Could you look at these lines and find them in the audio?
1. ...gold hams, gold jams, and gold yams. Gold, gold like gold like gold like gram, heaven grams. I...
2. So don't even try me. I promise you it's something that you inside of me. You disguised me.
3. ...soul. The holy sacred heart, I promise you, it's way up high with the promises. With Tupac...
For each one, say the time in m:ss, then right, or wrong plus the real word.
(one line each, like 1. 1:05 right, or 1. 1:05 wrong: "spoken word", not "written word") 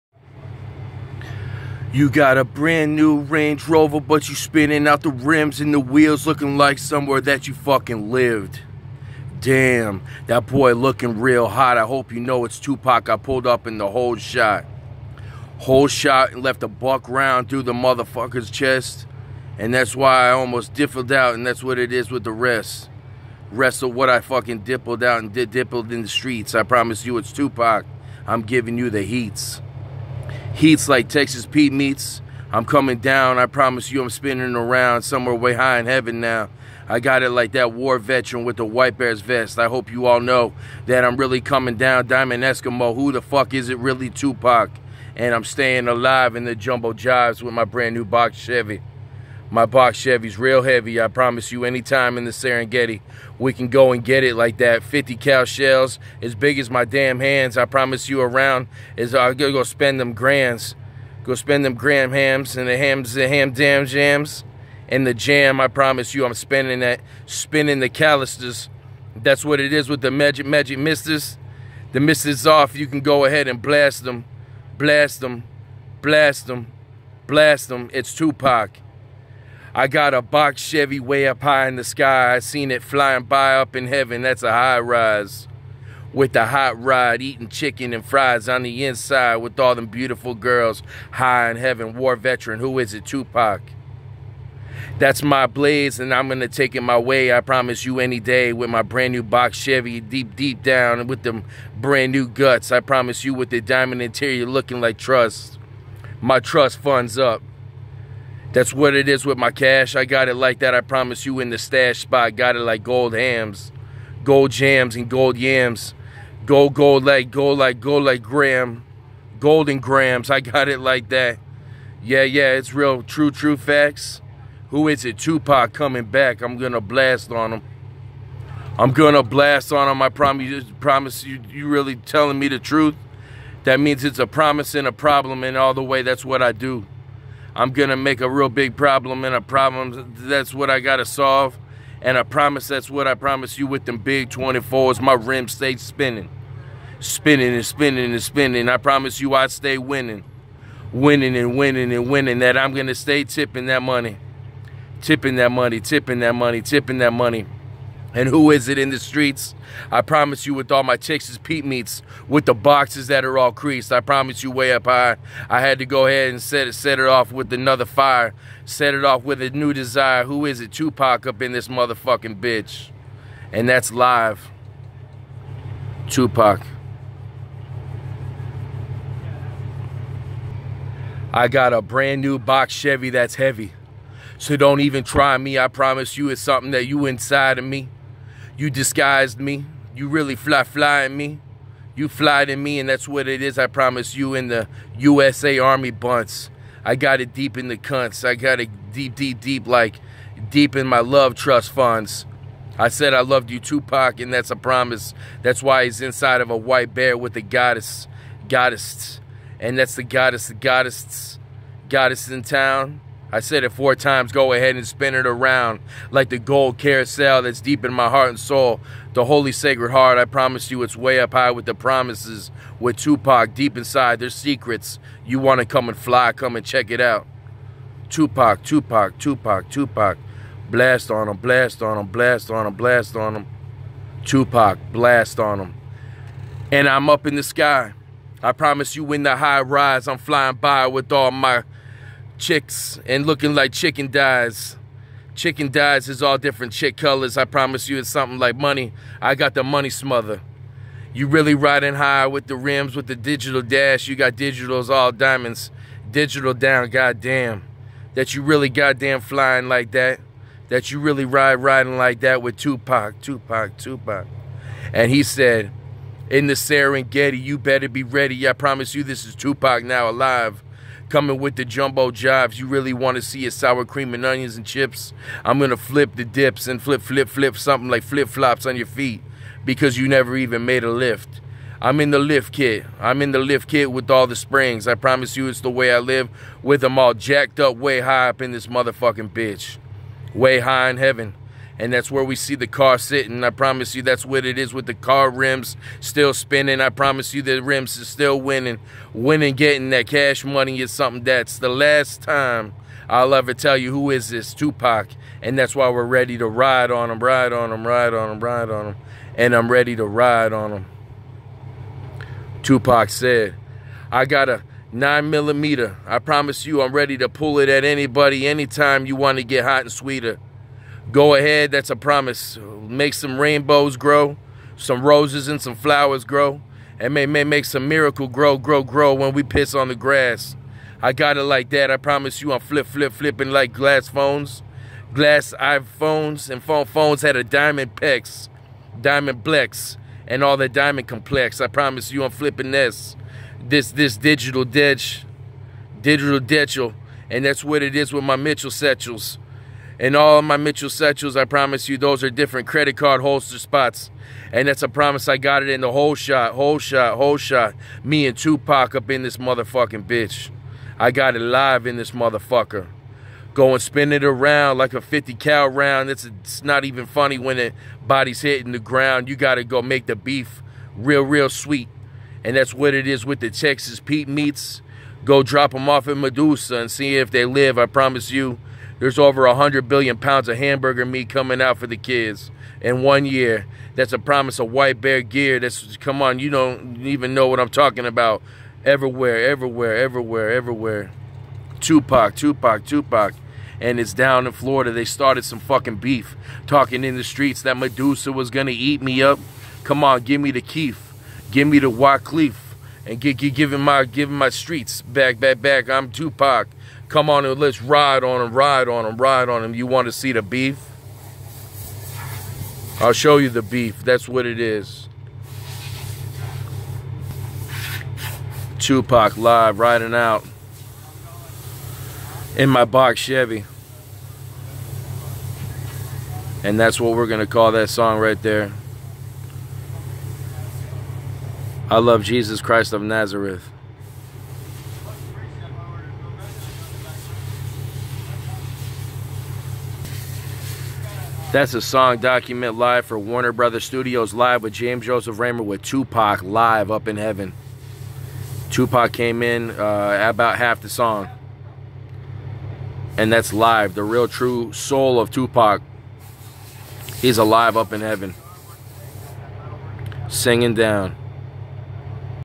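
1. 1:52 wrong: "golden", not "heaven"
2. 3:04 right
3. 3:38 right.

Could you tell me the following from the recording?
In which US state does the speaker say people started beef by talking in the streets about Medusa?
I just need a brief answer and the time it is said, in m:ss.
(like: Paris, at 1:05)
Florida, at 6:34.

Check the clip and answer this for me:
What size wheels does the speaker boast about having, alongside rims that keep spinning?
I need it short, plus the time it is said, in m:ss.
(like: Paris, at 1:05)
24s, at 2:24.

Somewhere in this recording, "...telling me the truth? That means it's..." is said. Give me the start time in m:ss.
2:11.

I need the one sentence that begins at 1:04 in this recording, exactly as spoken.
And the jam, I promise you, I'm spending that, spinning the calisters.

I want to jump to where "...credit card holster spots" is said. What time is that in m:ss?
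5:52.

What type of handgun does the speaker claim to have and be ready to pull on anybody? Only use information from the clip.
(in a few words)
nine millimeter.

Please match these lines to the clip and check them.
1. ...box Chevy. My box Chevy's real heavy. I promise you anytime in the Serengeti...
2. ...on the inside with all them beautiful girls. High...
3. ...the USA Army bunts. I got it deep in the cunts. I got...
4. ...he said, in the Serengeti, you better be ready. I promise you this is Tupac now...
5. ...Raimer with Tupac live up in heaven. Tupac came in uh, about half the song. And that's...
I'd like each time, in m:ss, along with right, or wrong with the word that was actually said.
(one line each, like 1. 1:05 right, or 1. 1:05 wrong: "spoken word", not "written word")
1. 0:48 right
2. 1:28 right
3. 3:14 right
4. 4:25 right
5. 7:25 right.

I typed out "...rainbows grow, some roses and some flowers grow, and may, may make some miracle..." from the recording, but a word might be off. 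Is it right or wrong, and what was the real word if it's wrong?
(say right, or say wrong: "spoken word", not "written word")
right.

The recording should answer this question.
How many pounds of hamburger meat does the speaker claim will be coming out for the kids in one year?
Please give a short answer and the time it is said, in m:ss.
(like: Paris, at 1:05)
100 billion, at 6:19.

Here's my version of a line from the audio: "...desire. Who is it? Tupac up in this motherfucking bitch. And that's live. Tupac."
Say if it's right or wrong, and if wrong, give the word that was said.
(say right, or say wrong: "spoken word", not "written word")
right.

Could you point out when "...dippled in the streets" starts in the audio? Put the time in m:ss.
0:25.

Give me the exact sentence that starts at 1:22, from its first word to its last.
I seen it flying by up in heaven.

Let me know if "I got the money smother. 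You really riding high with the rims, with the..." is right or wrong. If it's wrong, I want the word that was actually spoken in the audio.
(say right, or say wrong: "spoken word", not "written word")
right.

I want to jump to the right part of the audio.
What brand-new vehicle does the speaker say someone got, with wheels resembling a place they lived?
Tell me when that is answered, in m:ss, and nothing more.
0:03.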